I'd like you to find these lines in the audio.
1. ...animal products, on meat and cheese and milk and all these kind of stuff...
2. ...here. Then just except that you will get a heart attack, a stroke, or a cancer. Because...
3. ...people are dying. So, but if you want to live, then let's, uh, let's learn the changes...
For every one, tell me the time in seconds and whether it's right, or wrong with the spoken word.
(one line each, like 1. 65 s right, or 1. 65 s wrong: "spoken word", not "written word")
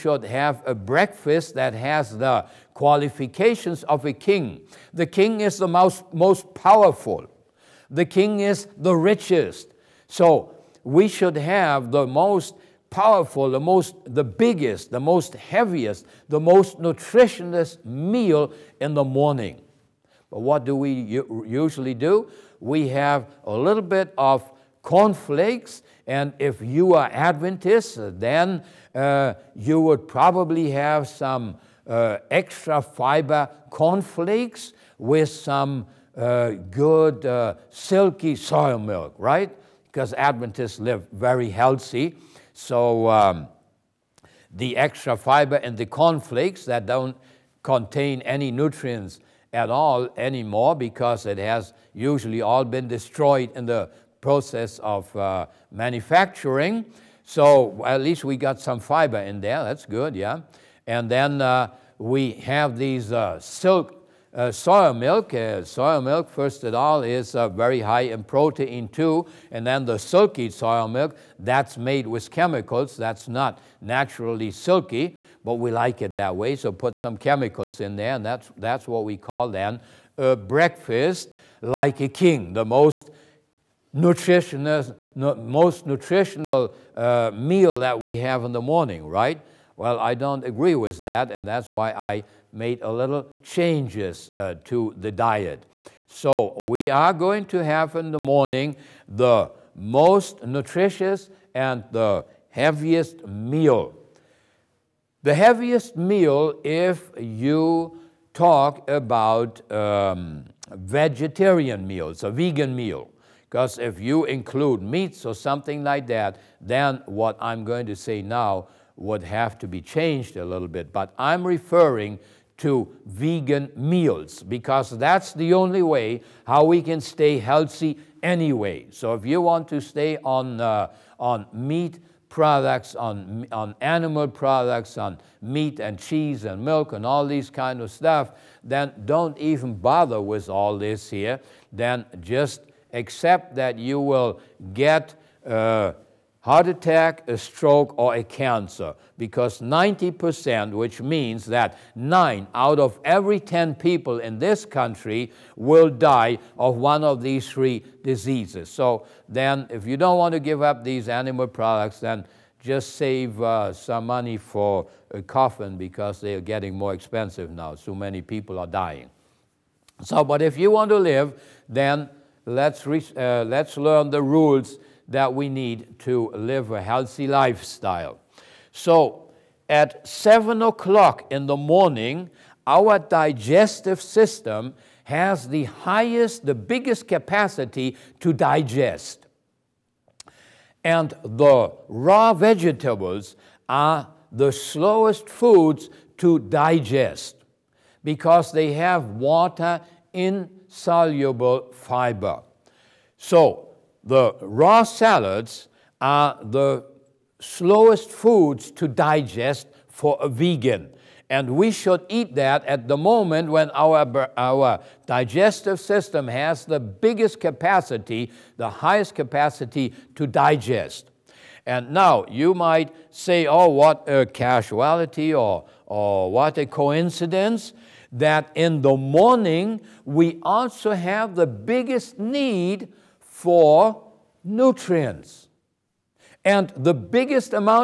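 1. 133 s right
2. 141 s right
3. 168 s wrong: "rules", not "changes".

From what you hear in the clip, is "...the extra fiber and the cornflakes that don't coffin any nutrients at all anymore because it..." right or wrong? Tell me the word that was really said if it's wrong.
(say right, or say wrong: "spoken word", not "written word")
wrong: "contain", not "coffin".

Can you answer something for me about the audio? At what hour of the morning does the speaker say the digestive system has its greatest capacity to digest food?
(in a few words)
7 o'clock.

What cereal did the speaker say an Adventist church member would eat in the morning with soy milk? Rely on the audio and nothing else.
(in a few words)
extra fiber cornflakes.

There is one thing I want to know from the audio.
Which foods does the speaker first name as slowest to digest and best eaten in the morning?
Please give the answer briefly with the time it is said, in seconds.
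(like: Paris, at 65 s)
raw vegetables, at 191 s.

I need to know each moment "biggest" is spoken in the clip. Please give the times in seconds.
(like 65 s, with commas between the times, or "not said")
14 s, 186 s, 216 s, 231 s, 236 s.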